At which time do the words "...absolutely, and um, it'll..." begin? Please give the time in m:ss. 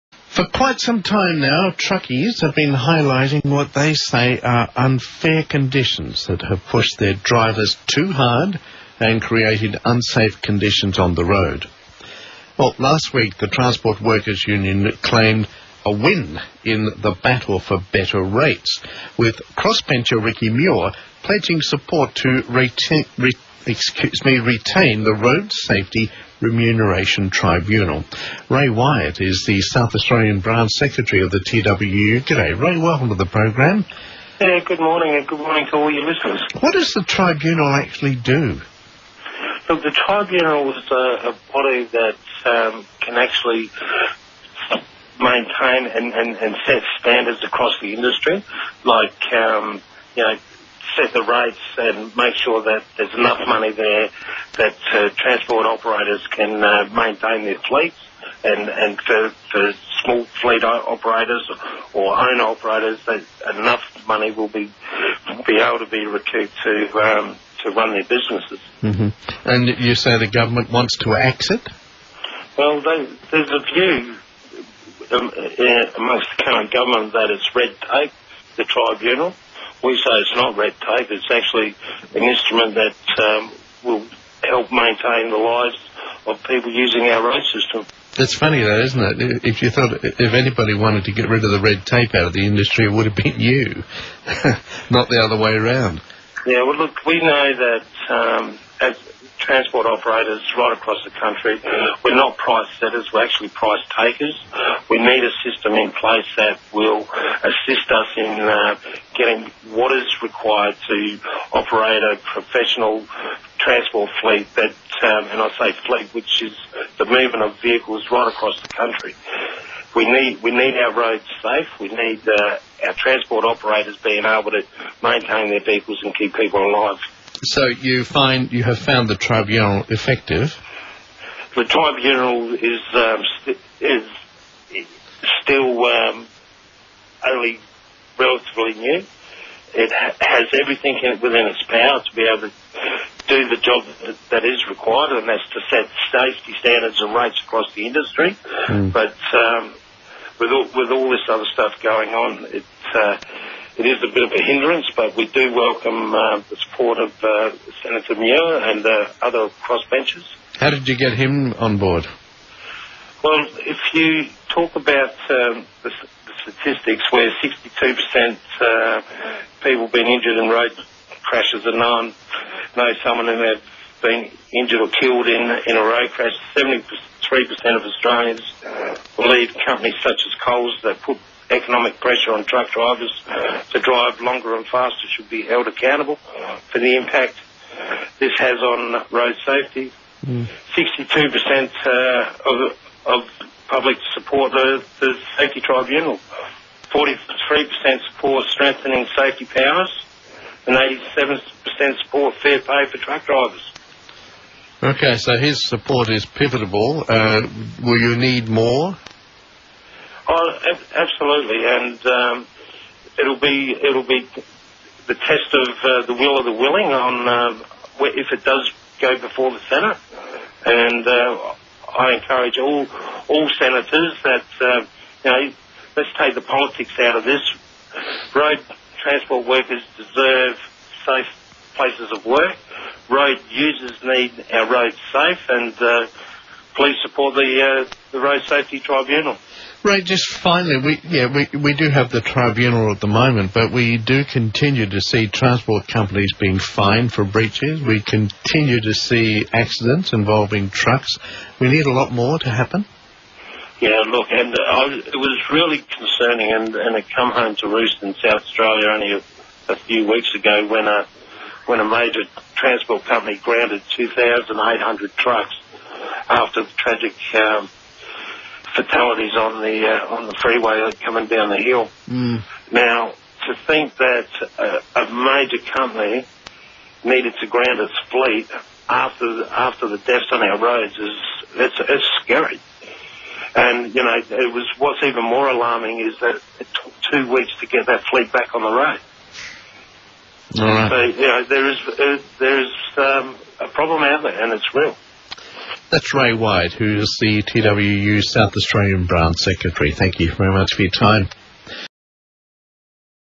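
3:30.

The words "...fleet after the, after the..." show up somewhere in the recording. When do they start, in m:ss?
4:38.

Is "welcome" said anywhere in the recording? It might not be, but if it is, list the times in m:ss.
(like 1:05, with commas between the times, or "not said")
0:32, 2:35.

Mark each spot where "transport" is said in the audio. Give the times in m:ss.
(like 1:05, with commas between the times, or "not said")
0:13, 0:55, 1:39, 1:53, 2:02, 3:49, 4:05, 4:22.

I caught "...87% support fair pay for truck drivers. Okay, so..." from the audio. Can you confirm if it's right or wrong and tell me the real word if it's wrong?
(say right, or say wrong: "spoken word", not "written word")
right.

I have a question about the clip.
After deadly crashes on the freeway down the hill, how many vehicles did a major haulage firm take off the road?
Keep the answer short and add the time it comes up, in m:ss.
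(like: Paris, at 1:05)
2,800, at 4:23.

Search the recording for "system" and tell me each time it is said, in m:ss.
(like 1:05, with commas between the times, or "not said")
1:27, 1:45.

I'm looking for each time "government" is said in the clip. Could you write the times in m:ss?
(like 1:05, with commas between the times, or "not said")
1:10, 1:16.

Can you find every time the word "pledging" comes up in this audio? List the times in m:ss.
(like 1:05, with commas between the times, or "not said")
0:21.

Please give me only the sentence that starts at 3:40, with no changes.
And uh, I encourage all all senators that, uh, you know, let's take the politics out of this.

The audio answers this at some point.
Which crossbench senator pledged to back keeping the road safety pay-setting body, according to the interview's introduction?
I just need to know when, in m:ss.
0:20.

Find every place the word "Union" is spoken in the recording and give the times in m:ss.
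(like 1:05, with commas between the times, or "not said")
0:14.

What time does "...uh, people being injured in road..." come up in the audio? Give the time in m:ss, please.
2:48.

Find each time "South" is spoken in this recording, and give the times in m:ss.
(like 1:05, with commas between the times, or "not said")
0:29, 4:18, 4:58.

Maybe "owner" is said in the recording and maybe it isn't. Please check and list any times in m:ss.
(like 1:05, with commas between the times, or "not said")
1:02.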